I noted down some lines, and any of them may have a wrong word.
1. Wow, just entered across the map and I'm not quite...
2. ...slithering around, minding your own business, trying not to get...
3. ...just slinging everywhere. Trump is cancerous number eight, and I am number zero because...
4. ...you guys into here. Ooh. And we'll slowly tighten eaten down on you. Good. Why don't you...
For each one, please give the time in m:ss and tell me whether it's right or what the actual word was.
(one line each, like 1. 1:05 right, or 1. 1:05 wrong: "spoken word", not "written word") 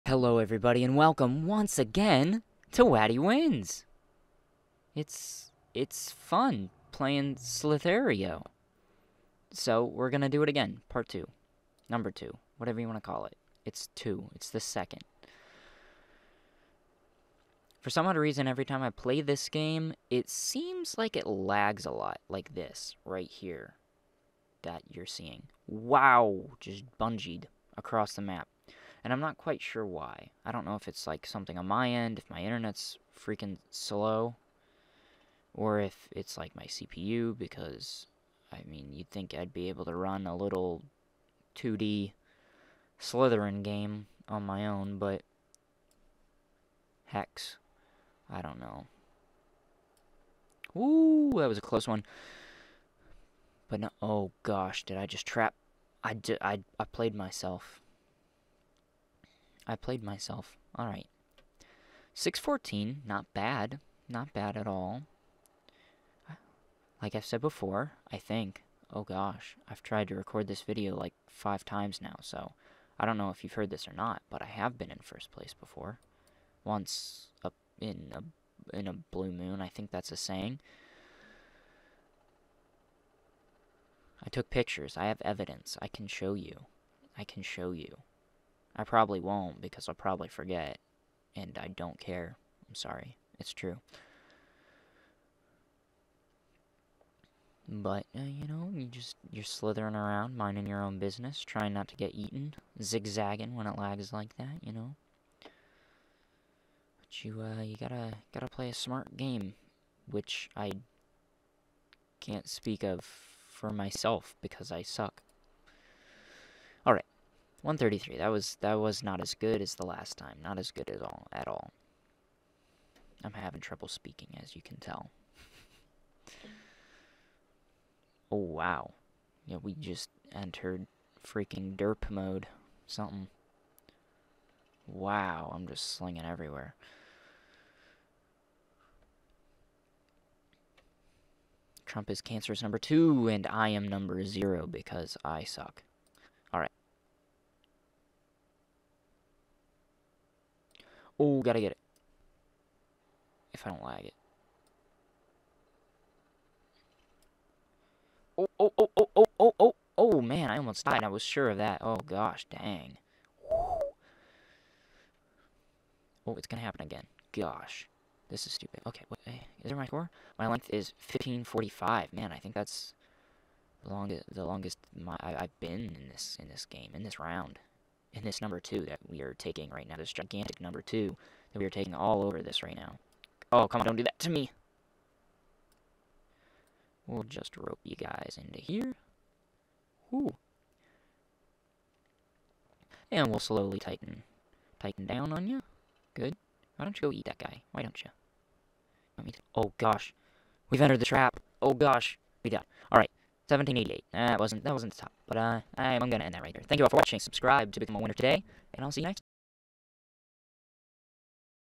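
1. 0:25 wrong: "bungeed", not "entered"
2. 1:39 right
3. 2:15 wrong: "two", not "eight"
4. 3:07 wrong: "tighten", not "eaten".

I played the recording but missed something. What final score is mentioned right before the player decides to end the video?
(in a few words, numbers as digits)
1788.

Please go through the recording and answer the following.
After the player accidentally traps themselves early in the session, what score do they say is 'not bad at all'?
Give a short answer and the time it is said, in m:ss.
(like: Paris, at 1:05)
614, at 1:02.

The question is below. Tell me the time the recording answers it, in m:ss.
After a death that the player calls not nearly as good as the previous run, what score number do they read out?
1:57.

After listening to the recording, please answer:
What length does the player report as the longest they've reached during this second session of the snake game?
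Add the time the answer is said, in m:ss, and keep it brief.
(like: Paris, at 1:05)
1545, at 2:51.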